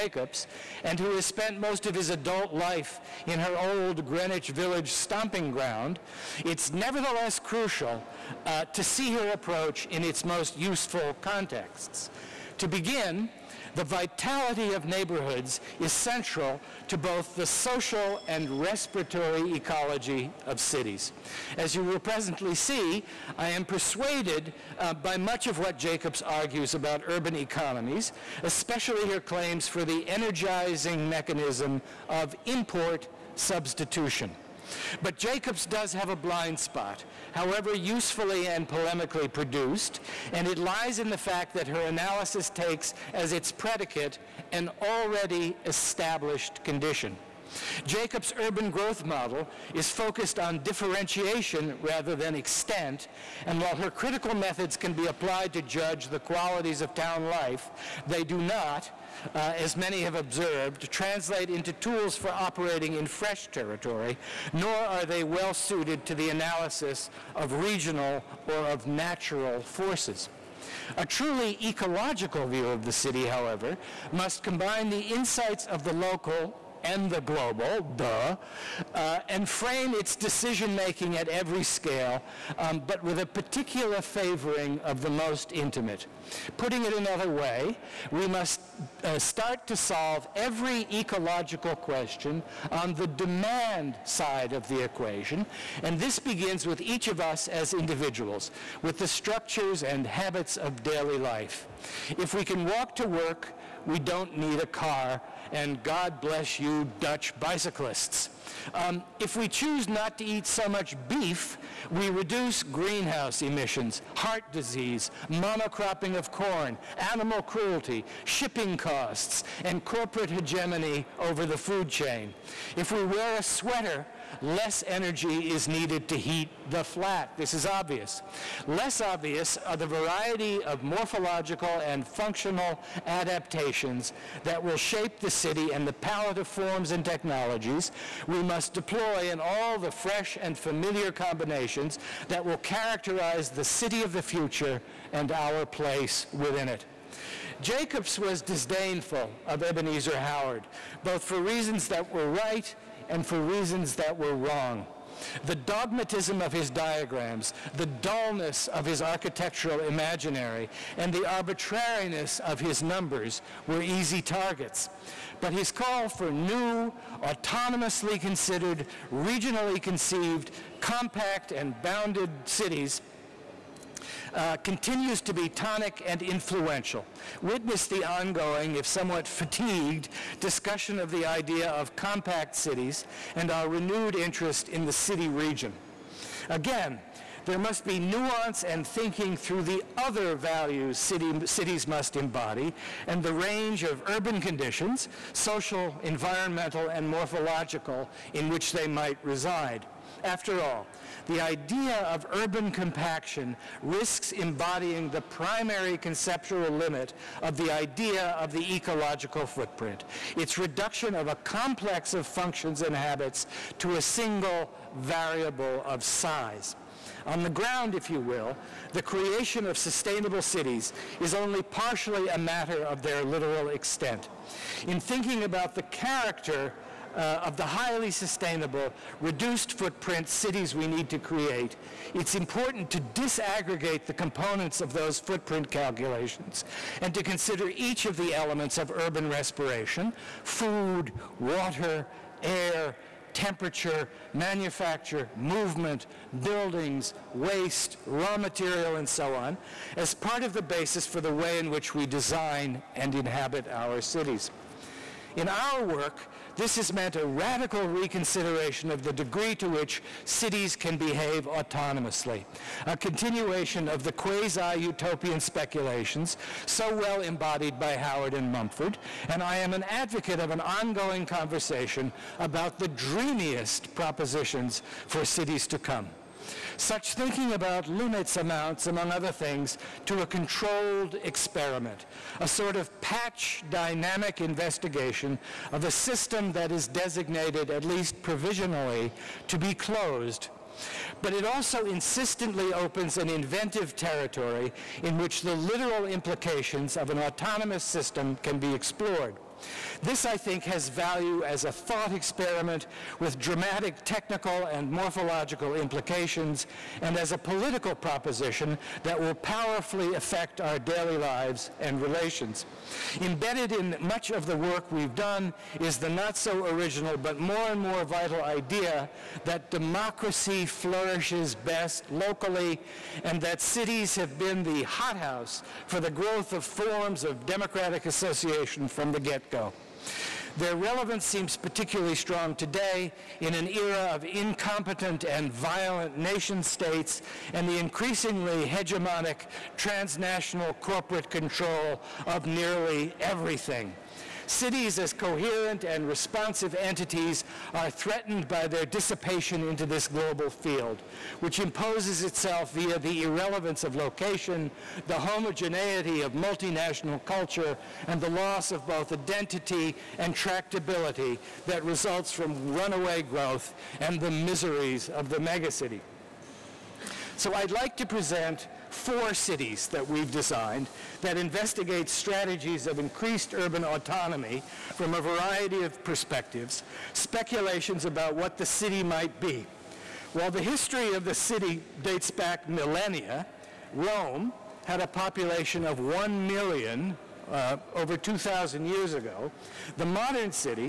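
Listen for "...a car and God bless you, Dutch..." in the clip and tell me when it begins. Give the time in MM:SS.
01:44.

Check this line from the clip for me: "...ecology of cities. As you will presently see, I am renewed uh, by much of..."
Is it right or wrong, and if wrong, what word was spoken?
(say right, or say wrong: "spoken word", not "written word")
wrong: "persuaded", not "renewed".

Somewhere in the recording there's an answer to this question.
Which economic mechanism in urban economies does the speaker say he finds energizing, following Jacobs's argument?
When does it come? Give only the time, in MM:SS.
00:32.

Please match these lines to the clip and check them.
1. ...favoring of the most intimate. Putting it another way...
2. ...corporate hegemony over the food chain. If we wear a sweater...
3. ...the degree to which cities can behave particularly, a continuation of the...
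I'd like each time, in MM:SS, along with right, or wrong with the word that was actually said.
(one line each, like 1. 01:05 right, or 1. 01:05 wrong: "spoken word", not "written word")
1. 01:24 right
2. 01:59 right
3. 04:19 wrong: "autonomously", not "particularly".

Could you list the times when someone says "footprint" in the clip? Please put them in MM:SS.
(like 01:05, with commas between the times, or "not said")
03:29, 03:49, 03:55.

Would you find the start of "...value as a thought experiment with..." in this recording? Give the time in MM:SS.
05:00.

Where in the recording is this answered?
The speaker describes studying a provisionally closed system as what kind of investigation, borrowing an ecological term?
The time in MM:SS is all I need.
04:43.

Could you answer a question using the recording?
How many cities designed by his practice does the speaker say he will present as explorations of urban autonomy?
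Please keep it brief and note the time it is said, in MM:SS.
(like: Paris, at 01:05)
4, at 06:08.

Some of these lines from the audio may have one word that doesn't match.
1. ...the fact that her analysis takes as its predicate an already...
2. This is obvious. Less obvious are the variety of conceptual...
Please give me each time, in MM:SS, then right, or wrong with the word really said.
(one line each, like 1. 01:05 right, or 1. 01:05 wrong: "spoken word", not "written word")
1. 00:41 right
2. 02:07 wrong: "morphological", not "conceptual".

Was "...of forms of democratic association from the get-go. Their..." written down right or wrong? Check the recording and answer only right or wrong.
right.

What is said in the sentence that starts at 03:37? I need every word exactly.
On the ground, if you will, the creation of sustainable cities is only partially a matter of their literal extent.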